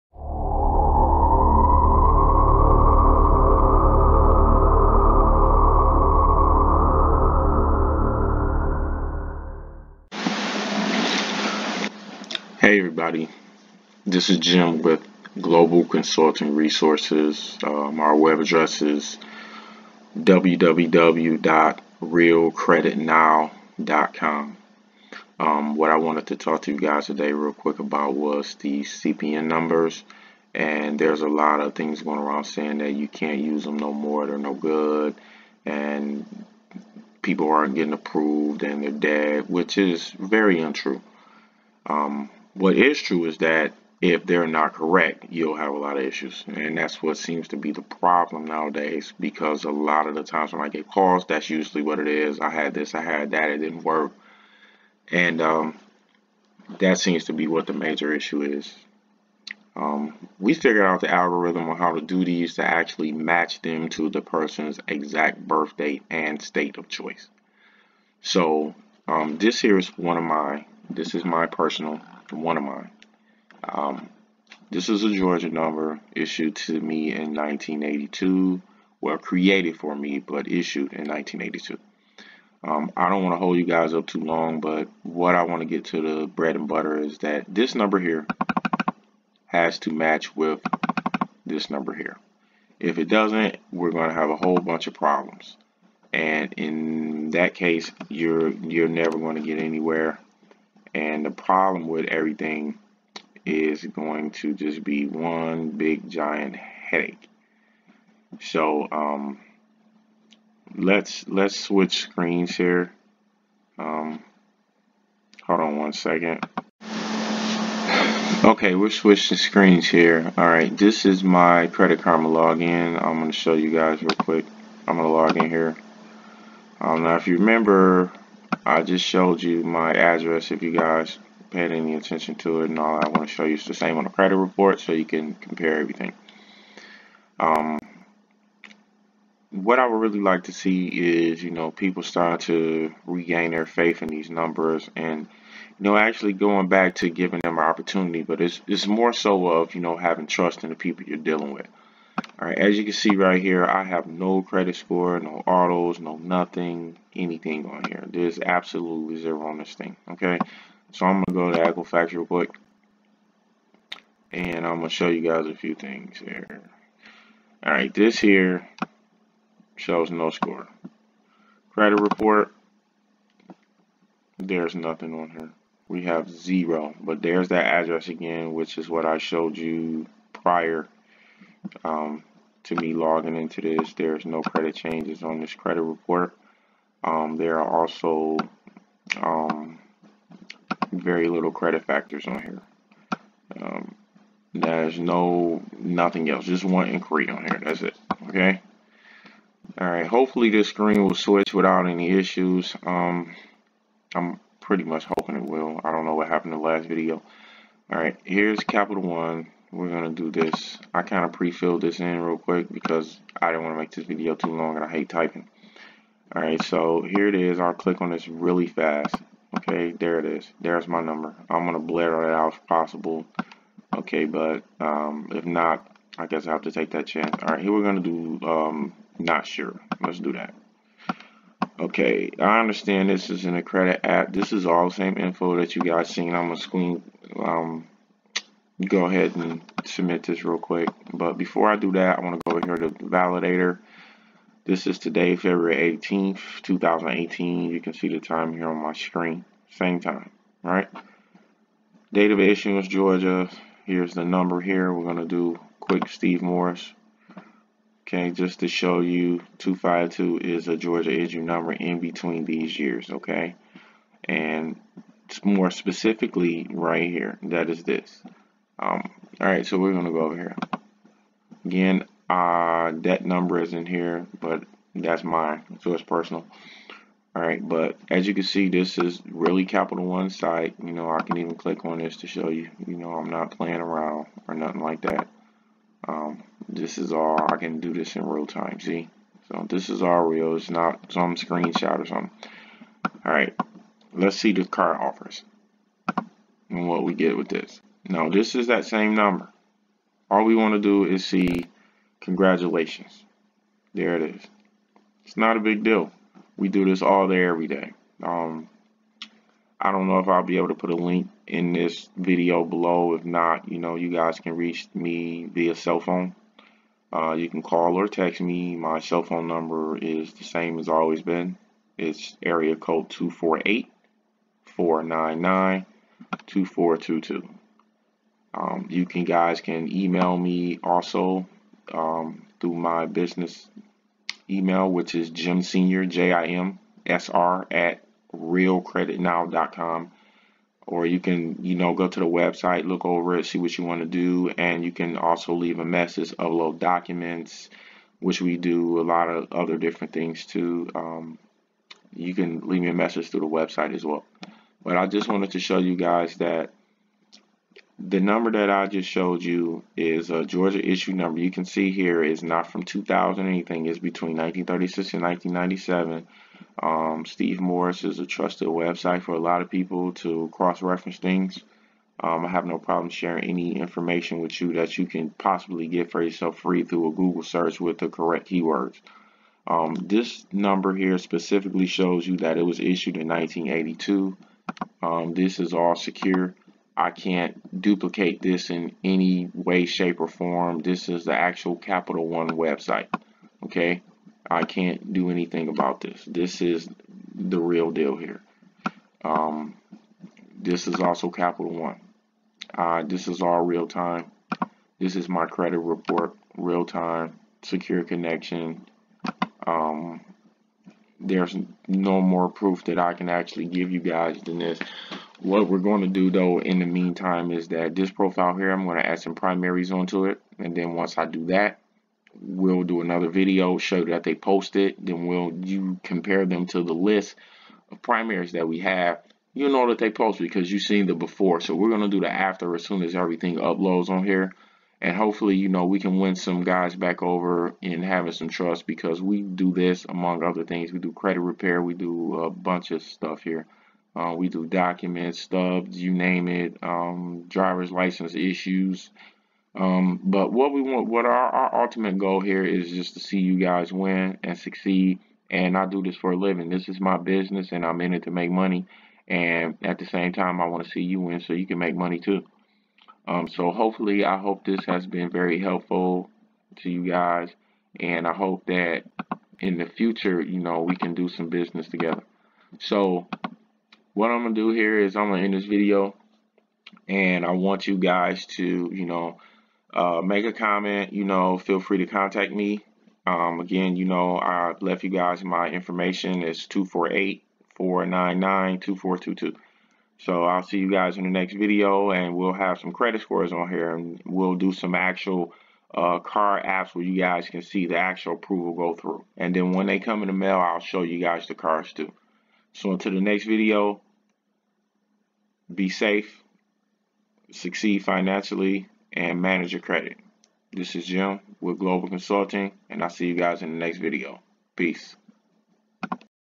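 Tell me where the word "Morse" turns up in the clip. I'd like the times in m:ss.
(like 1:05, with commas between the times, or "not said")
4:16, 6:07.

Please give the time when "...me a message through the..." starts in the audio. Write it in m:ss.
5:52.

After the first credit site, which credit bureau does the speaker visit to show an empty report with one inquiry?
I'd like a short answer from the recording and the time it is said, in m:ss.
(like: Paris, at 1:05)
Equifax, at 2:41.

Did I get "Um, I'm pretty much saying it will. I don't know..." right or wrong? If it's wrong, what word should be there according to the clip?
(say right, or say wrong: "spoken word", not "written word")
wrong: "hoping", not "saying".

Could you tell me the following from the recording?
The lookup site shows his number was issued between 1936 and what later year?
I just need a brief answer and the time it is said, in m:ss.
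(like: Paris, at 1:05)
1997, at 6:05.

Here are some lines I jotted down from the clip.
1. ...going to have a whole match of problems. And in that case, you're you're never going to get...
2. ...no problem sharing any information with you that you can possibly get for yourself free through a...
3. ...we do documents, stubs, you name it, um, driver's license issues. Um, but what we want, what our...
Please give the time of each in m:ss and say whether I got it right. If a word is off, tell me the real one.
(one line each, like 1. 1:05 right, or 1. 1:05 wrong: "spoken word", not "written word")
1. 1:33 wrong: "bunch", not "match"
2. 6:12 right
3. 7:24 right.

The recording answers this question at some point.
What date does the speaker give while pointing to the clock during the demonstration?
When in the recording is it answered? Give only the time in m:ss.
4:05.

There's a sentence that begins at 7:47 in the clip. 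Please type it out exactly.
And I hope that in the future, you know, we can do some business together.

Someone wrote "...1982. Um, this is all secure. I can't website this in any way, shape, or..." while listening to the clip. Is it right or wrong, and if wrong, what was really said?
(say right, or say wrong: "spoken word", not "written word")
wrong: "duplicate", not "website".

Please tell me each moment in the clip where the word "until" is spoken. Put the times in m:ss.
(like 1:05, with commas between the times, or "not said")
8:22.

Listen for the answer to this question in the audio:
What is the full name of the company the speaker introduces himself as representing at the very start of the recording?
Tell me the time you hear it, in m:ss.
0:15.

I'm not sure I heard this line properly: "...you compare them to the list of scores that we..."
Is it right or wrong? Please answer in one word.
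wrong.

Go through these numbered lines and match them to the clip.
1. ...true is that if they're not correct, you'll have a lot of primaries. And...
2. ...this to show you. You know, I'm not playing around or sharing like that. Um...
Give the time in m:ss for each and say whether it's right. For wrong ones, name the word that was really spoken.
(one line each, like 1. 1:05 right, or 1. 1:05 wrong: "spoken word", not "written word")
1. 0:43 wrong: "issues", not "primaries"
2. 4:41 wrong: "nothing", not "sharing".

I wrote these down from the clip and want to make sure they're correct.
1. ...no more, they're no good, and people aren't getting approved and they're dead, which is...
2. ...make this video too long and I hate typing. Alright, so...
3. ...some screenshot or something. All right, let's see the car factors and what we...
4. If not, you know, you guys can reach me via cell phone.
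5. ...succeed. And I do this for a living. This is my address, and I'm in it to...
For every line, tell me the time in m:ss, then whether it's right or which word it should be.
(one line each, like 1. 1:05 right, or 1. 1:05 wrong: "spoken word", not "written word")
1. 0:33 right
2. 3:33 right
3. 4:51 wrong: "offers", not "factors"
4. 5:13 right
5. 7:34 wrong: "business", not "address".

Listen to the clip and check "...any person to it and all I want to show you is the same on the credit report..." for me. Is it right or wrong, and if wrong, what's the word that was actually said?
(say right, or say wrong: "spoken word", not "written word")
wrong: "attention", not "person".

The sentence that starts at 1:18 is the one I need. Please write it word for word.
Well, created for me, but issued in 1982.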